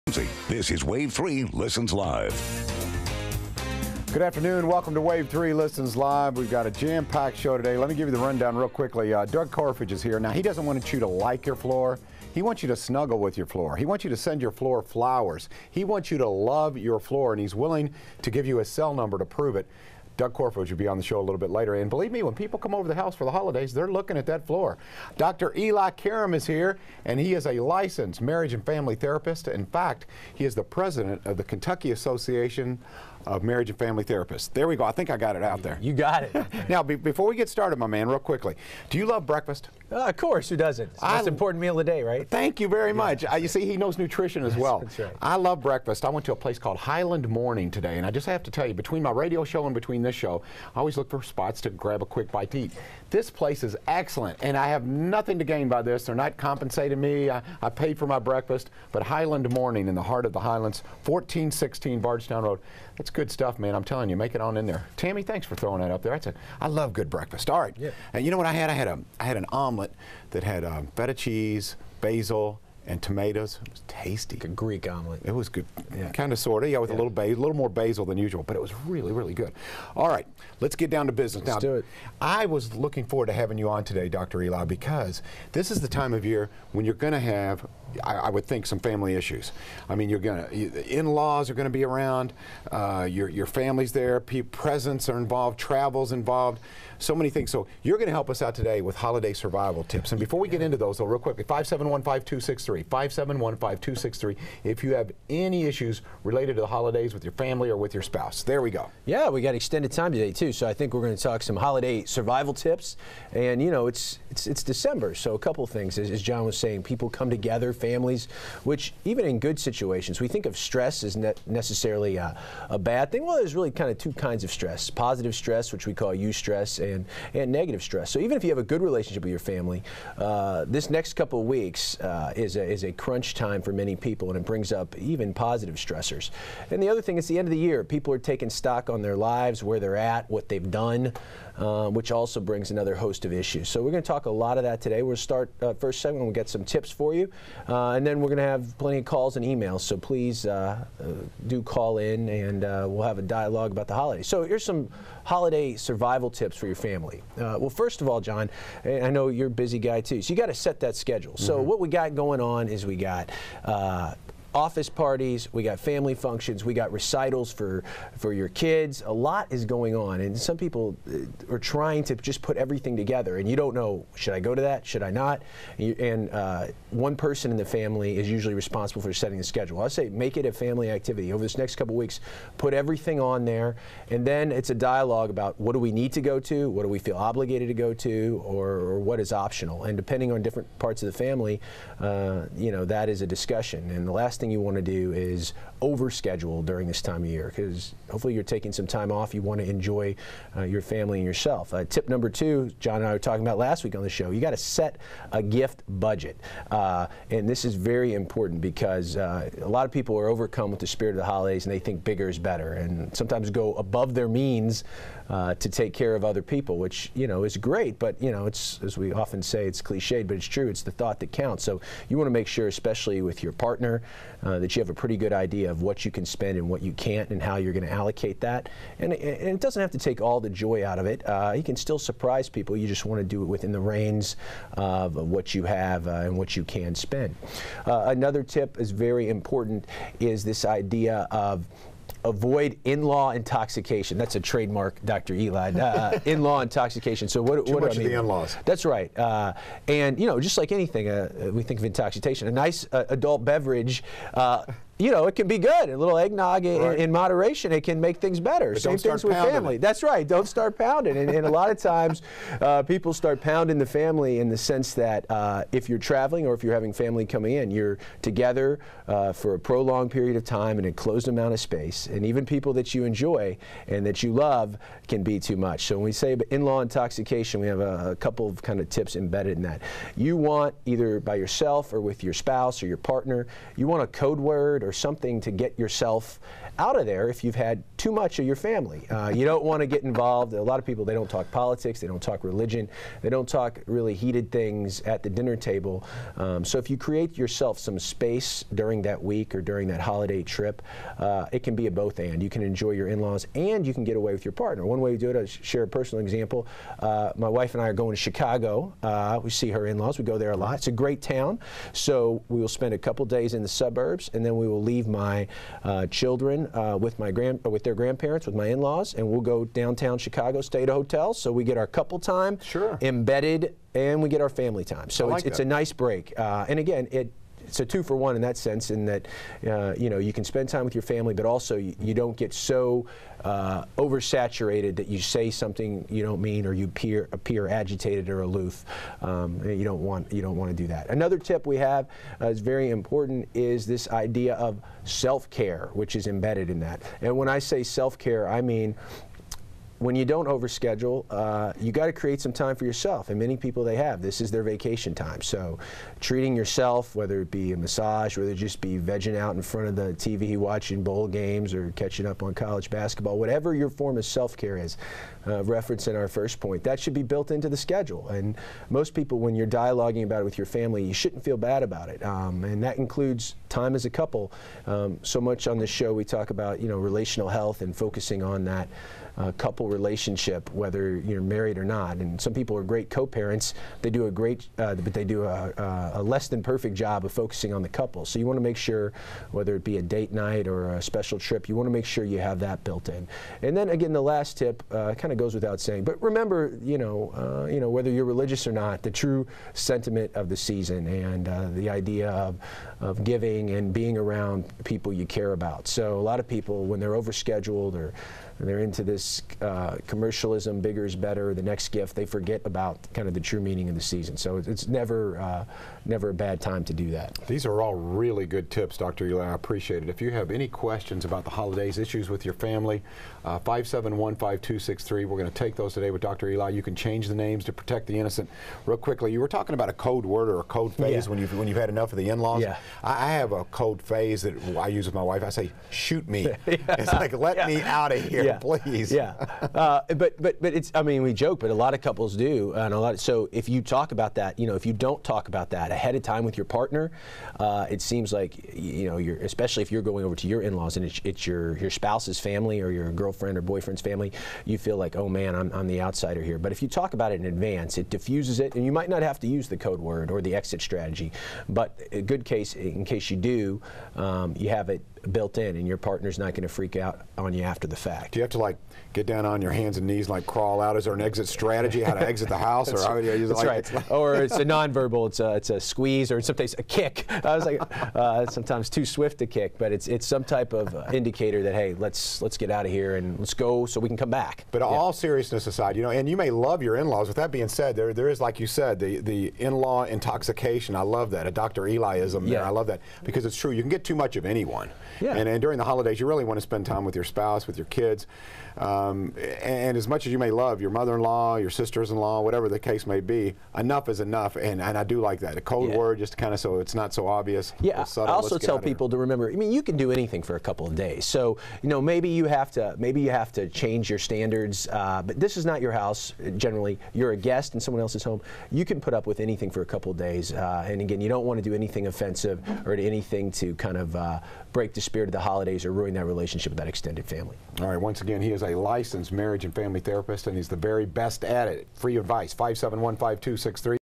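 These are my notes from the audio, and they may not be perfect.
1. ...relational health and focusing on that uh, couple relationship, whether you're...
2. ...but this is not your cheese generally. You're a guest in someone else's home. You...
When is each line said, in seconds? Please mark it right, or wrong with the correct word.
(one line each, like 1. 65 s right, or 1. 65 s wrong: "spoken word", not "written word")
1. 376 s right
2. 515 s wrong: "house", not "cheese".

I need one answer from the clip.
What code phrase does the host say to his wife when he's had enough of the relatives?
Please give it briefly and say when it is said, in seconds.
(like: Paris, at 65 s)
Shoot me, at 435 s.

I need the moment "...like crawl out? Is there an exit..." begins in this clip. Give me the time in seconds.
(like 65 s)
470 s.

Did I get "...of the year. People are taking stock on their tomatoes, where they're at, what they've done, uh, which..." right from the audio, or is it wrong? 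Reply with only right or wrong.
wrong.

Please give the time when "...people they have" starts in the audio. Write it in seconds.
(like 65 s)
353 s.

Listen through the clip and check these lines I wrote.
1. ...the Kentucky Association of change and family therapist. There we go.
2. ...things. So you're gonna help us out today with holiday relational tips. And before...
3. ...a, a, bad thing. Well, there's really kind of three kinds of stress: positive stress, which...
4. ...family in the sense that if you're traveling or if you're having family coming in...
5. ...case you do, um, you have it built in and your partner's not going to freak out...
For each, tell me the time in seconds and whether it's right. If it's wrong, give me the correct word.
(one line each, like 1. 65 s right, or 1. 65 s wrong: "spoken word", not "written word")
1. 31 s wrong: "marriage", not "change"
2. 97 s wrong: "survival", not "relational"
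3. 122 s wrong: "two", not "three"
4. 263 s right
5. 463 s right.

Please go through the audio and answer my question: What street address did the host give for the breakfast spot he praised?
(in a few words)
1416 Bardstown Road.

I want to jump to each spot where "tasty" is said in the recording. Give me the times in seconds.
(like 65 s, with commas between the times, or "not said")
73 s.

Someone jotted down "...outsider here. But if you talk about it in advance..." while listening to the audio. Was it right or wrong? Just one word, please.
right.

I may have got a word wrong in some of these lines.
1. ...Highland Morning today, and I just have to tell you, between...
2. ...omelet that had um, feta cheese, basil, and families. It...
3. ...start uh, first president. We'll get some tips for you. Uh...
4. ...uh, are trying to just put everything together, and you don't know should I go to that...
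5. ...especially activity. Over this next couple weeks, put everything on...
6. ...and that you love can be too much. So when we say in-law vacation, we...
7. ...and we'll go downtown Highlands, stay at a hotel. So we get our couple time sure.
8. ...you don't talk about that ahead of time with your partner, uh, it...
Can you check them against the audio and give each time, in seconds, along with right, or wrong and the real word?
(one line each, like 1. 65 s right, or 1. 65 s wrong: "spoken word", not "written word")
1. 46 s right
2. 69 s wrong: "tomatoes", not "families"
3. 145 s wrong: "segment", not "president"
4. 171 s right
5. 180 s wrong: "family", not "especially"
6. 273 s wrong: "intoxication", not "vacation"
7. 319 s wrong: "Chicago", not "Highlands"
8. 444 s right.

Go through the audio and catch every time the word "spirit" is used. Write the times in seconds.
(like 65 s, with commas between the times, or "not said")
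210 s, 525 s.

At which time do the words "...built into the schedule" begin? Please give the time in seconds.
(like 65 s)
367 s.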